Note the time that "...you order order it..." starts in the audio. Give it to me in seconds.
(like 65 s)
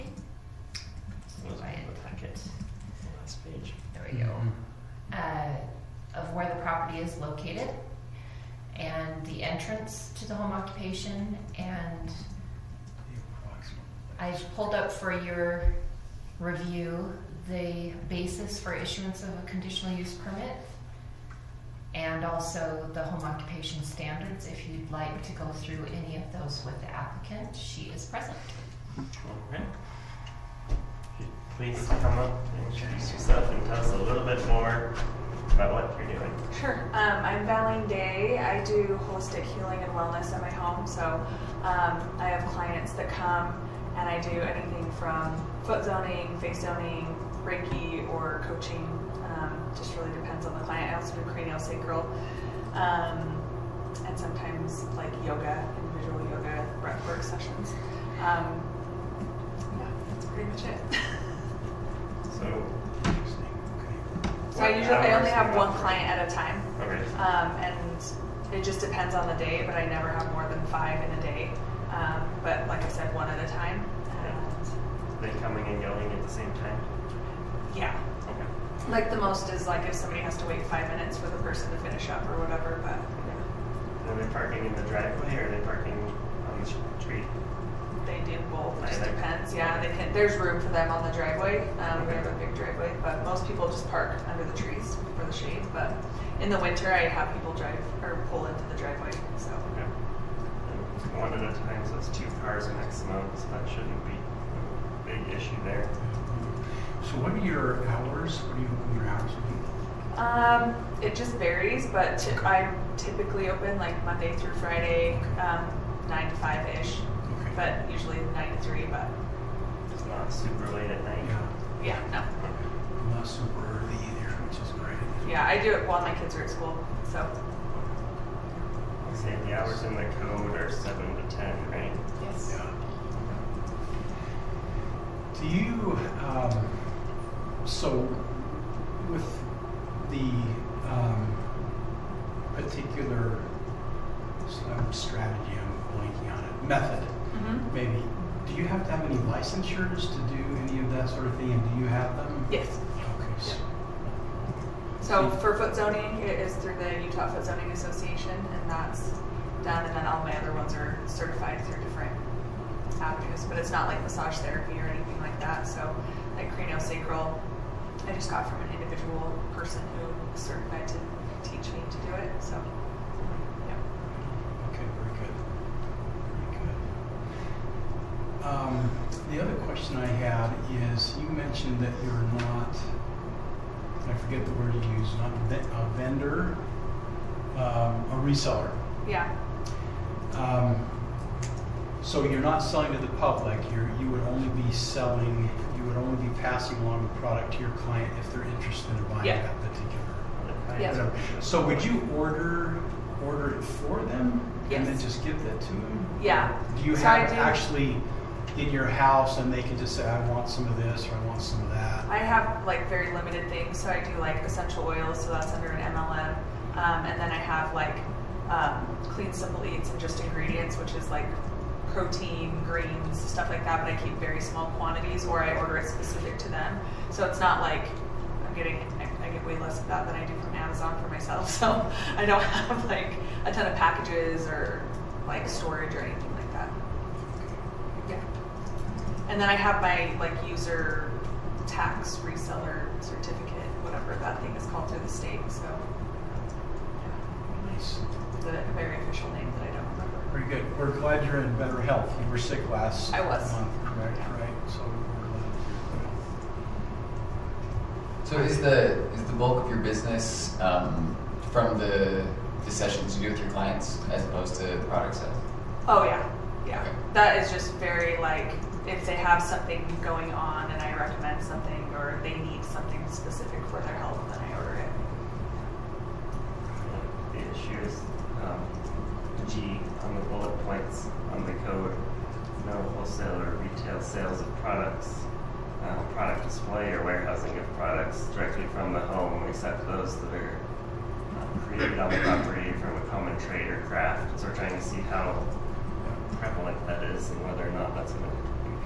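201 s.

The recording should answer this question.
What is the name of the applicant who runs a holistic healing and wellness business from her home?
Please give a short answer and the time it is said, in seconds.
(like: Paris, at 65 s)
Valleen Day, at 37 s.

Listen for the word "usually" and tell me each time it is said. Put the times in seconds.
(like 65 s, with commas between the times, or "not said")
64 s, 117 s.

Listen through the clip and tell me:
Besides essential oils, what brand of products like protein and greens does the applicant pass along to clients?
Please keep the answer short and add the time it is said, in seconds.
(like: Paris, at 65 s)
Clean Simple Eats, at 219 s.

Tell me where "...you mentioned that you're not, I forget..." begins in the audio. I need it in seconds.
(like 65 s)
181 s.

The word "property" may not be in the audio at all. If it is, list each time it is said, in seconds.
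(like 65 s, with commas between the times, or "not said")
6 s, 292 s.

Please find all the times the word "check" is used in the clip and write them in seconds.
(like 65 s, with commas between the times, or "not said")
not said.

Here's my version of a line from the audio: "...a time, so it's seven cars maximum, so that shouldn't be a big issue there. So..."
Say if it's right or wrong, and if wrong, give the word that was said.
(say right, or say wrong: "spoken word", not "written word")
wrong: "two", not "seven".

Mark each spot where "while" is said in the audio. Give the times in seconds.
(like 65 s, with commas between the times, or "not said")
125 s.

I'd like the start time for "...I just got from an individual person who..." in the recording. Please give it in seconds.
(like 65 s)
168 s.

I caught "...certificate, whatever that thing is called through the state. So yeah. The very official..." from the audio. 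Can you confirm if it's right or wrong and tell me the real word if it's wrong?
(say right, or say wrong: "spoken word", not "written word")
right.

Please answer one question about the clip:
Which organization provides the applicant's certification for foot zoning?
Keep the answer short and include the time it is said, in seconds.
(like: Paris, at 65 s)
Utah Foot Zoning Association, at 157 s.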